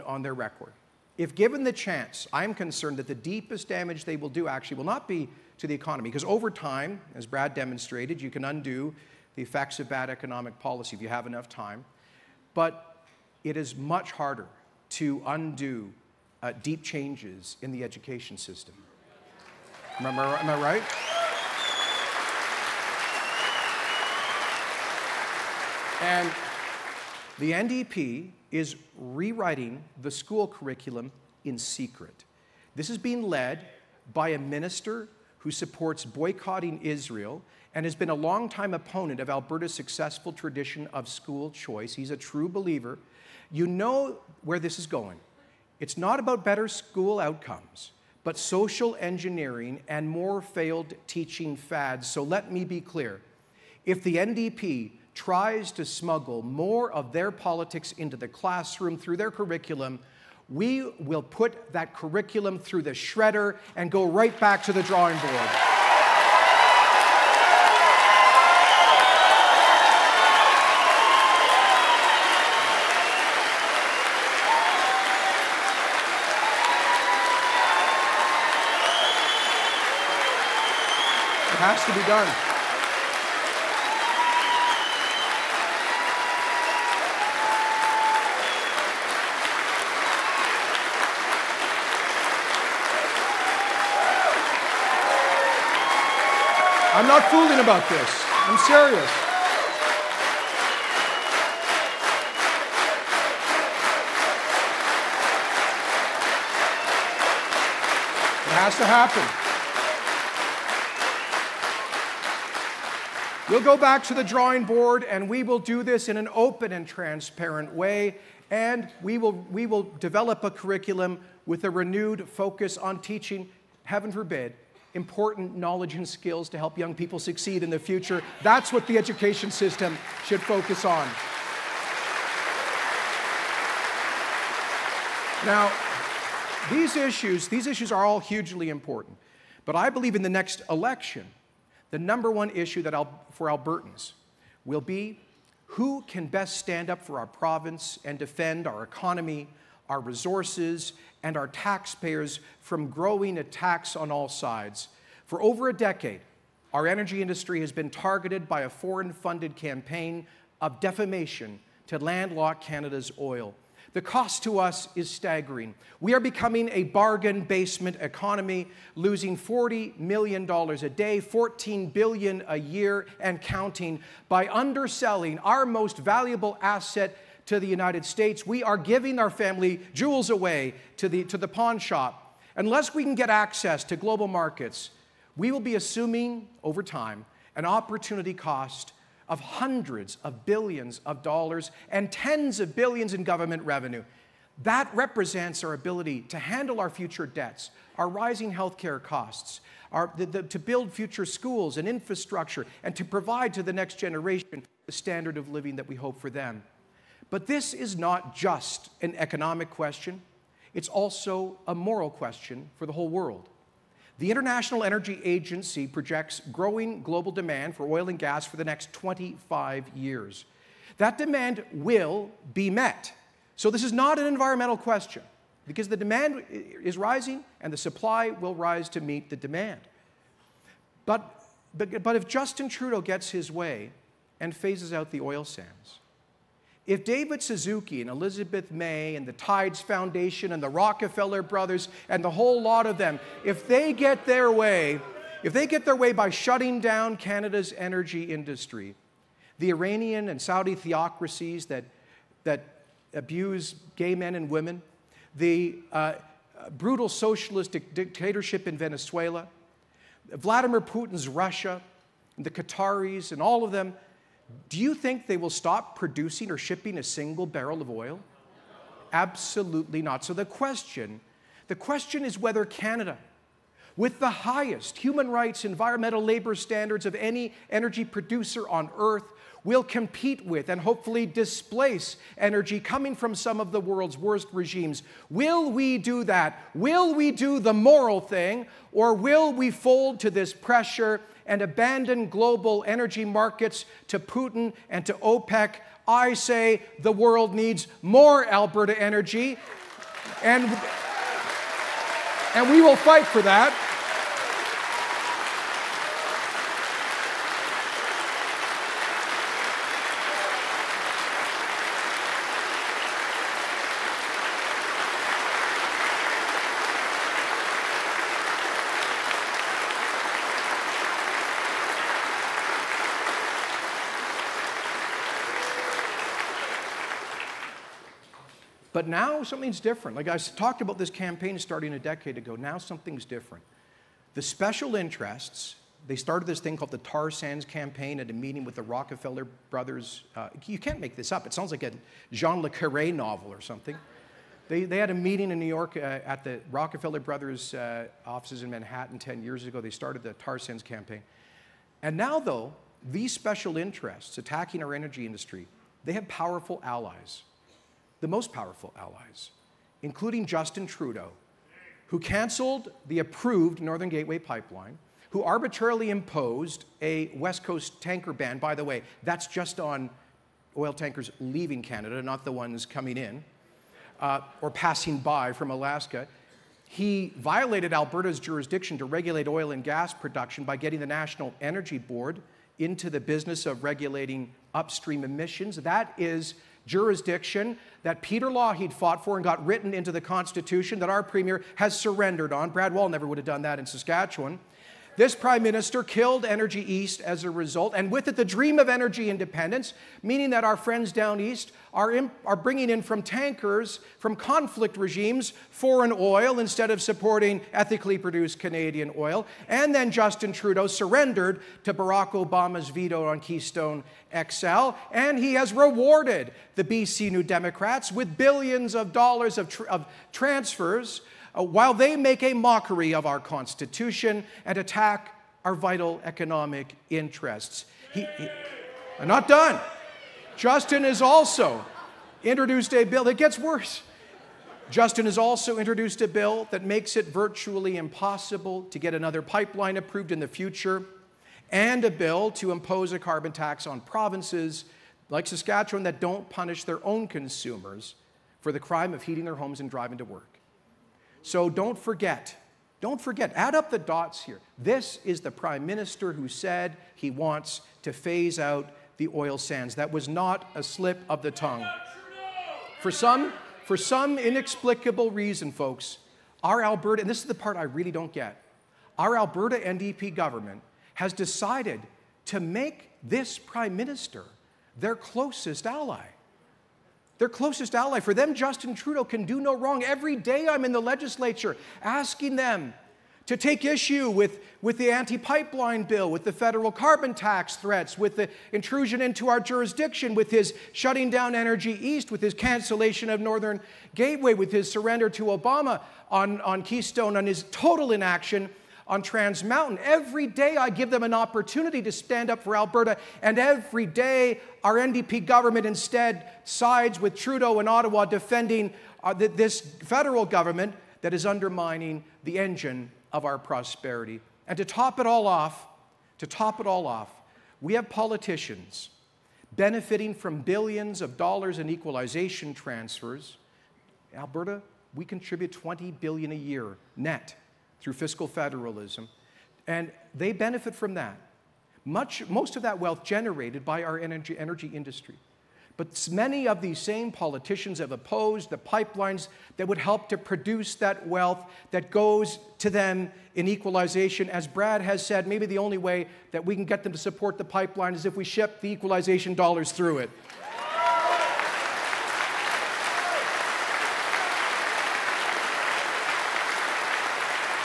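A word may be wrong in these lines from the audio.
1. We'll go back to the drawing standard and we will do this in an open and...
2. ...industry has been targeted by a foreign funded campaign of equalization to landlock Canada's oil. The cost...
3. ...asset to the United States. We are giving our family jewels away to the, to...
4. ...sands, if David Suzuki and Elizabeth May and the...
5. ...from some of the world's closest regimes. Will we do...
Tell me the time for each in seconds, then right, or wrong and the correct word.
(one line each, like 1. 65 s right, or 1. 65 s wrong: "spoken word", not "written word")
1. 113 s wrong: "board", not "standard"
2. 157 s wrong: "defamation", not "equalization"
3. 176 s right
4. 235 s right
5. 283 s wrong: "worst", not "closest".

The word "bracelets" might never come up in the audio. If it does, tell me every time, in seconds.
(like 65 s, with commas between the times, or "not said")
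not said.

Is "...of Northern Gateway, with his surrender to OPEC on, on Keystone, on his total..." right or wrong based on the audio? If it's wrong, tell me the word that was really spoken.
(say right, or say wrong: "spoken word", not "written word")
wrong: "Obama", not "OPEC".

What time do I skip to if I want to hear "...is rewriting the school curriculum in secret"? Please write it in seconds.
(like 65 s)
28 s.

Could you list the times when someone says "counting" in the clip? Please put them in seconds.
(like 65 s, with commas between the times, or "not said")
173 s.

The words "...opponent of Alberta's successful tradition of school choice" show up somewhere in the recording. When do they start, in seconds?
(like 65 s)
38 s.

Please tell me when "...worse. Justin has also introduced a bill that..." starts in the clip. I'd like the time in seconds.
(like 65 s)
433 s.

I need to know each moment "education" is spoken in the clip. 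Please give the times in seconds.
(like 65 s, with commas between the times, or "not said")
17 s, 128 s.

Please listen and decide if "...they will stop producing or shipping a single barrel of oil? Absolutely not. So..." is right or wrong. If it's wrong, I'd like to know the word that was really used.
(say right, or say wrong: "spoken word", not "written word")
right.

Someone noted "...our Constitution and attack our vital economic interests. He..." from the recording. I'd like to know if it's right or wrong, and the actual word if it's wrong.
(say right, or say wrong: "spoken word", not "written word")
right.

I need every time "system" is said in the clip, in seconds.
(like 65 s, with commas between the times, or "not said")
18 s, 129 s.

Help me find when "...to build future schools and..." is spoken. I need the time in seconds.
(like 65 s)
200 s.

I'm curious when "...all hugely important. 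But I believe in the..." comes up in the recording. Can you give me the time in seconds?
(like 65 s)
138 s.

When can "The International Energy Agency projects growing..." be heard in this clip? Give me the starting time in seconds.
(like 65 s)
214 s.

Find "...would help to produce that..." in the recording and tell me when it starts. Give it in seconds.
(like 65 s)
539 s.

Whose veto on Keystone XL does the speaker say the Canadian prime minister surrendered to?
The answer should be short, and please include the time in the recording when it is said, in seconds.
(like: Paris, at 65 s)
Barack Obama, at 411 s.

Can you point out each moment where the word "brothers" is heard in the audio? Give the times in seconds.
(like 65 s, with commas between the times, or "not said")
241 s, 339 s, 347 s.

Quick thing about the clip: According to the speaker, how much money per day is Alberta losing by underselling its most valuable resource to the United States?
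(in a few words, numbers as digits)
$40 million.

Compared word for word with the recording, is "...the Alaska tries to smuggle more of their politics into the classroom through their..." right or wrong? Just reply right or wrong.
wrong.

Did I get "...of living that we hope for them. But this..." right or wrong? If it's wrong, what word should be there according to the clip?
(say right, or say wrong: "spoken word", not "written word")
right.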